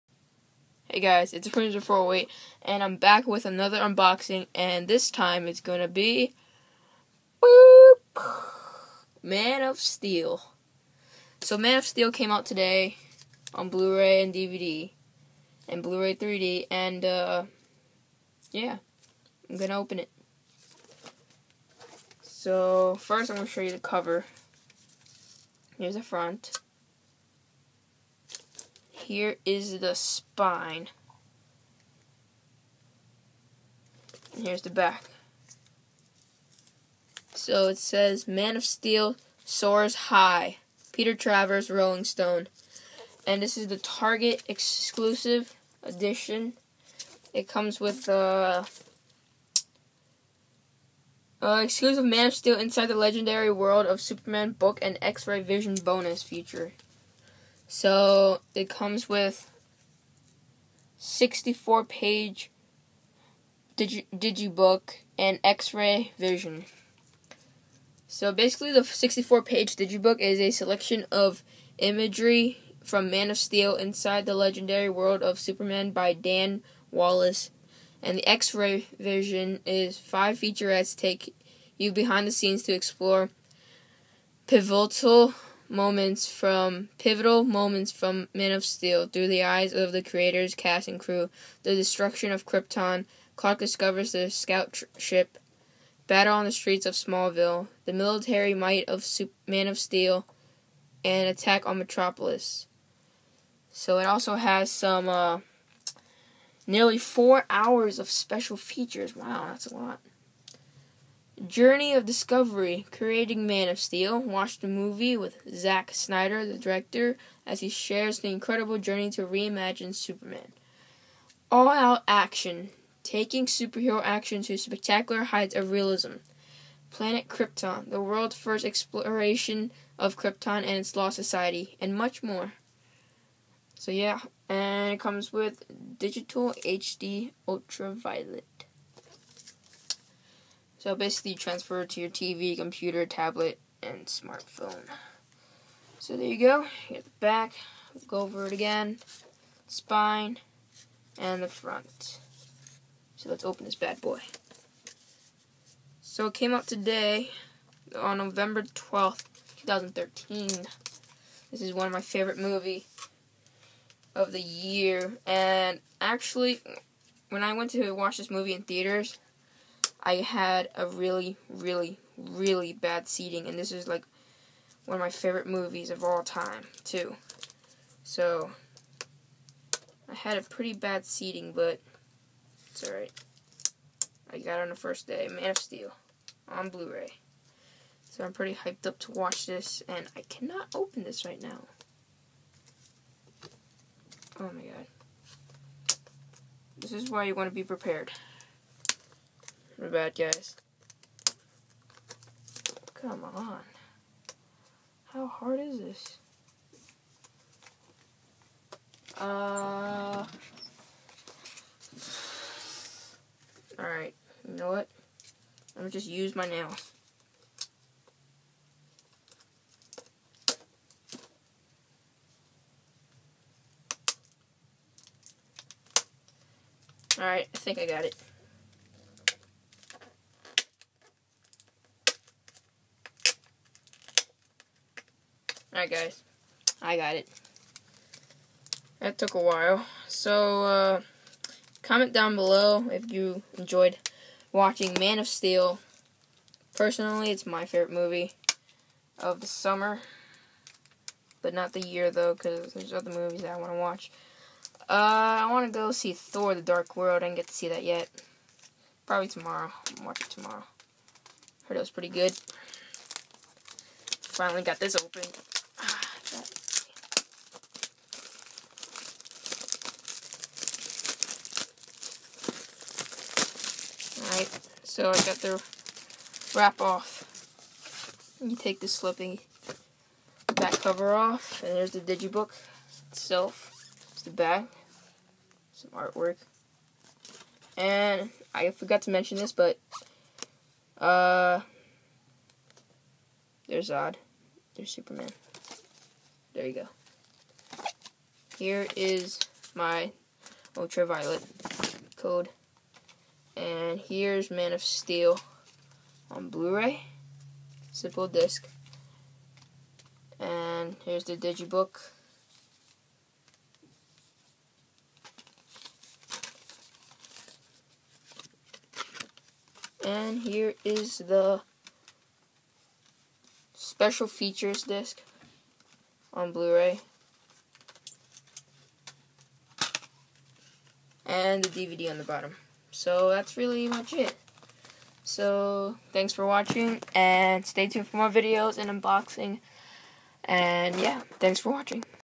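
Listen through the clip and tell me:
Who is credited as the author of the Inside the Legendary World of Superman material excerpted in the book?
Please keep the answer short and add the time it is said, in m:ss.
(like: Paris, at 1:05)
Dan Wallace, at 1:16.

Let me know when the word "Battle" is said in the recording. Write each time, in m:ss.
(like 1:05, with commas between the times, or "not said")
1:36.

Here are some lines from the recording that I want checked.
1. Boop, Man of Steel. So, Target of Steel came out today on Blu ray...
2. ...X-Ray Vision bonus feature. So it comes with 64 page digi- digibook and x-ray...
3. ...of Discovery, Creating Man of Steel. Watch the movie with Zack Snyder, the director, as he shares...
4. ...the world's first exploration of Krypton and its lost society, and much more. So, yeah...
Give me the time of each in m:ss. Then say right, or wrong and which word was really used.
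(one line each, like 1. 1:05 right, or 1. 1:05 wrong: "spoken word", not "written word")
1. 0:07 wrong: "Man", not "Target"
2. 0:55 right
3. 1:51 right
4. 2:07 right.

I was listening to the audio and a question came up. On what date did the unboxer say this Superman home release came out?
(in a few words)
November 12th, 2013.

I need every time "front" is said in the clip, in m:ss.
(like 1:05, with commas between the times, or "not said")
0:26, 2:31.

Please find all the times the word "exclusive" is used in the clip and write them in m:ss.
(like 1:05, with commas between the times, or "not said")
0:44, 0:51.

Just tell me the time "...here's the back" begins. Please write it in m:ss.
0:34.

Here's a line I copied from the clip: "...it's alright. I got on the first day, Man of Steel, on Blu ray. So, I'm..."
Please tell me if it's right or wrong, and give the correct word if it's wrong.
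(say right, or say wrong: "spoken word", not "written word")
right.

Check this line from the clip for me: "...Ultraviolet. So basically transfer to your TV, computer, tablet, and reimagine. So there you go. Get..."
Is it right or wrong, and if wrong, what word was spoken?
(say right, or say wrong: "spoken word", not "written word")
wrong: "smartphone", not "reimagine".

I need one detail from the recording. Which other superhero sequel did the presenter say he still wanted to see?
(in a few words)
Thor The Dark World.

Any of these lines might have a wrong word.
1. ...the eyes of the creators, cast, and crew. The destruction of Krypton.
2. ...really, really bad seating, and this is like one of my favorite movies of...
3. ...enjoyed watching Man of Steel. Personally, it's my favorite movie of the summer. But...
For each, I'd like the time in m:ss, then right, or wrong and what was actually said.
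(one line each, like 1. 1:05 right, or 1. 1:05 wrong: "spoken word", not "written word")
1. 1:29 right
2. 2:51 right
3. 4:03 right.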